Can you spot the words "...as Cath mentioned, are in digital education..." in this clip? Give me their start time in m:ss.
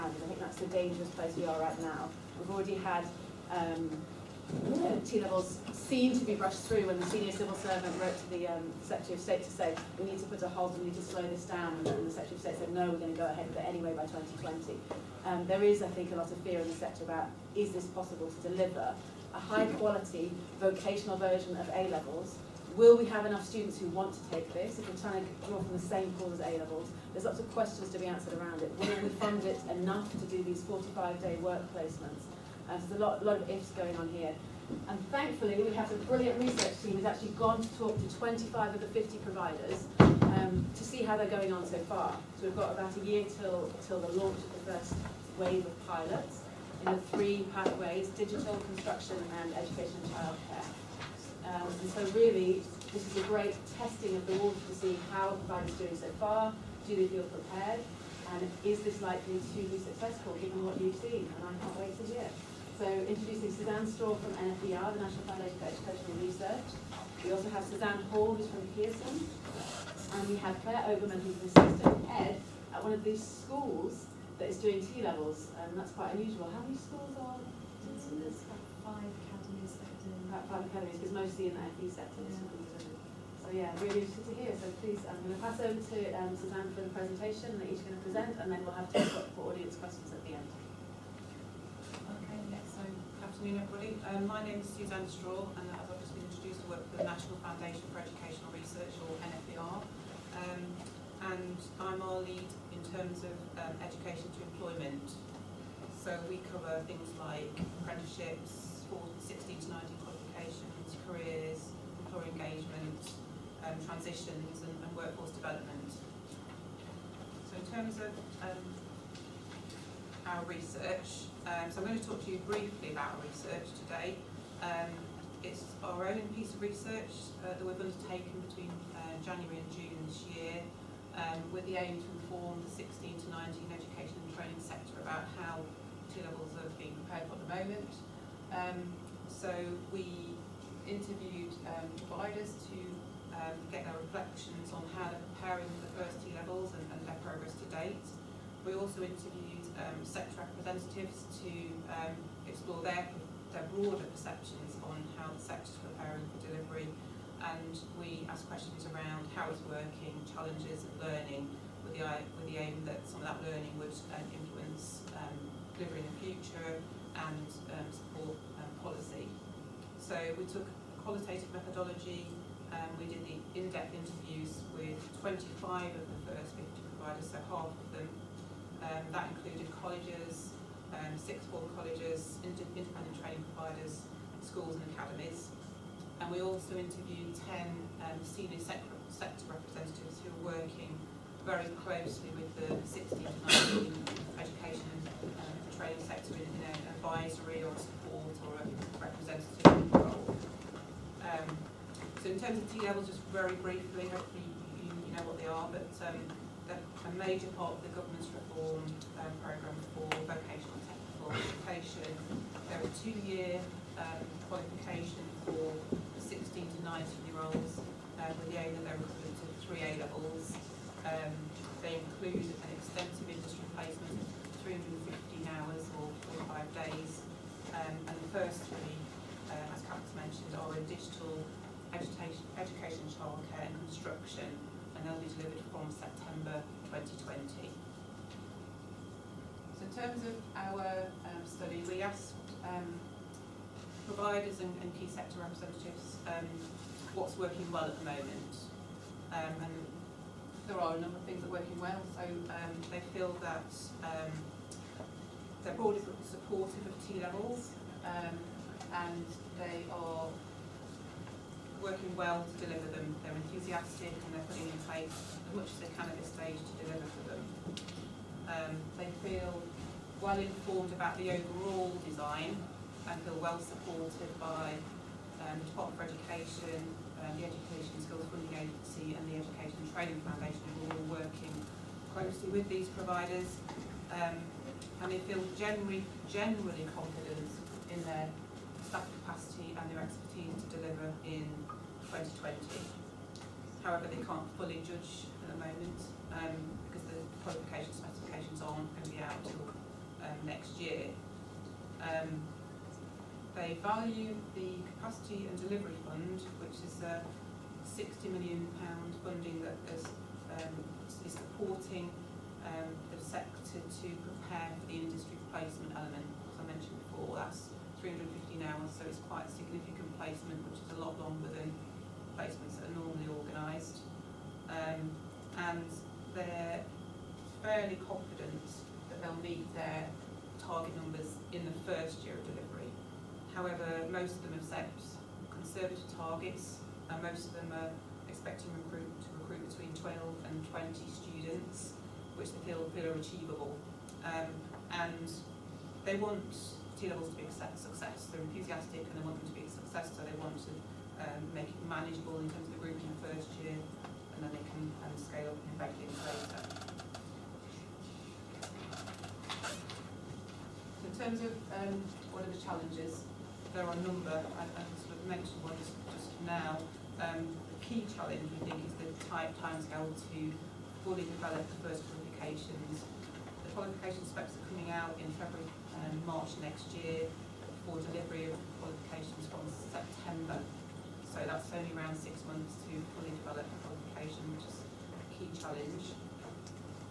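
3:49.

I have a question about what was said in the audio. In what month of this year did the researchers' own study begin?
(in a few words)
January.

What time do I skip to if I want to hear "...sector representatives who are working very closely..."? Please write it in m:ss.
3:09.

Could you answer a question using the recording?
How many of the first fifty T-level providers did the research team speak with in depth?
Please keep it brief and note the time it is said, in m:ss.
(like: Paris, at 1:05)
25, at 0:38.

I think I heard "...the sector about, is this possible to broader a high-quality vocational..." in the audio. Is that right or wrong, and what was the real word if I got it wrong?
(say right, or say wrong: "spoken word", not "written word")
wrong: "deliver", not "broader".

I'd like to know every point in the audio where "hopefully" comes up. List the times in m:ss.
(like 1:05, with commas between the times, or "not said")
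3:24.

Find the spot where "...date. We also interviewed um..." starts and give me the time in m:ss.
2:27.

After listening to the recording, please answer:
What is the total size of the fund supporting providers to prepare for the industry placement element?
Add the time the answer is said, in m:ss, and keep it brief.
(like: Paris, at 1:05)
£60 million, at 5:07.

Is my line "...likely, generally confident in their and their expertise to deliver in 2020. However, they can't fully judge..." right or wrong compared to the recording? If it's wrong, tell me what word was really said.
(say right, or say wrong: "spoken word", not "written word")
wrong: "generally", not "likely".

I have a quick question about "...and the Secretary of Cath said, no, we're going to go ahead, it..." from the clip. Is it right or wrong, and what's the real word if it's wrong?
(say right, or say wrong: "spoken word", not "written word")
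wrong: "State", not "Cath".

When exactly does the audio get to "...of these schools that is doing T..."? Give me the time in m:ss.
1:12.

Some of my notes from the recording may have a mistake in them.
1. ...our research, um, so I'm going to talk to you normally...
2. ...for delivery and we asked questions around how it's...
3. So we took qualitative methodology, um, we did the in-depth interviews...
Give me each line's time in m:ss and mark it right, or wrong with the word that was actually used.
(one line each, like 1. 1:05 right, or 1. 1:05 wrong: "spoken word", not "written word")
1. 2:00 wrong: "briefly", not "normally"
2. 2:36 right
3. 2:50 right.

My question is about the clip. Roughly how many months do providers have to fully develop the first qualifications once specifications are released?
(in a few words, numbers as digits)
6.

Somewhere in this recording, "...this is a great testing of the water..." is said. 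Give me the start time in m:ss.
0:52.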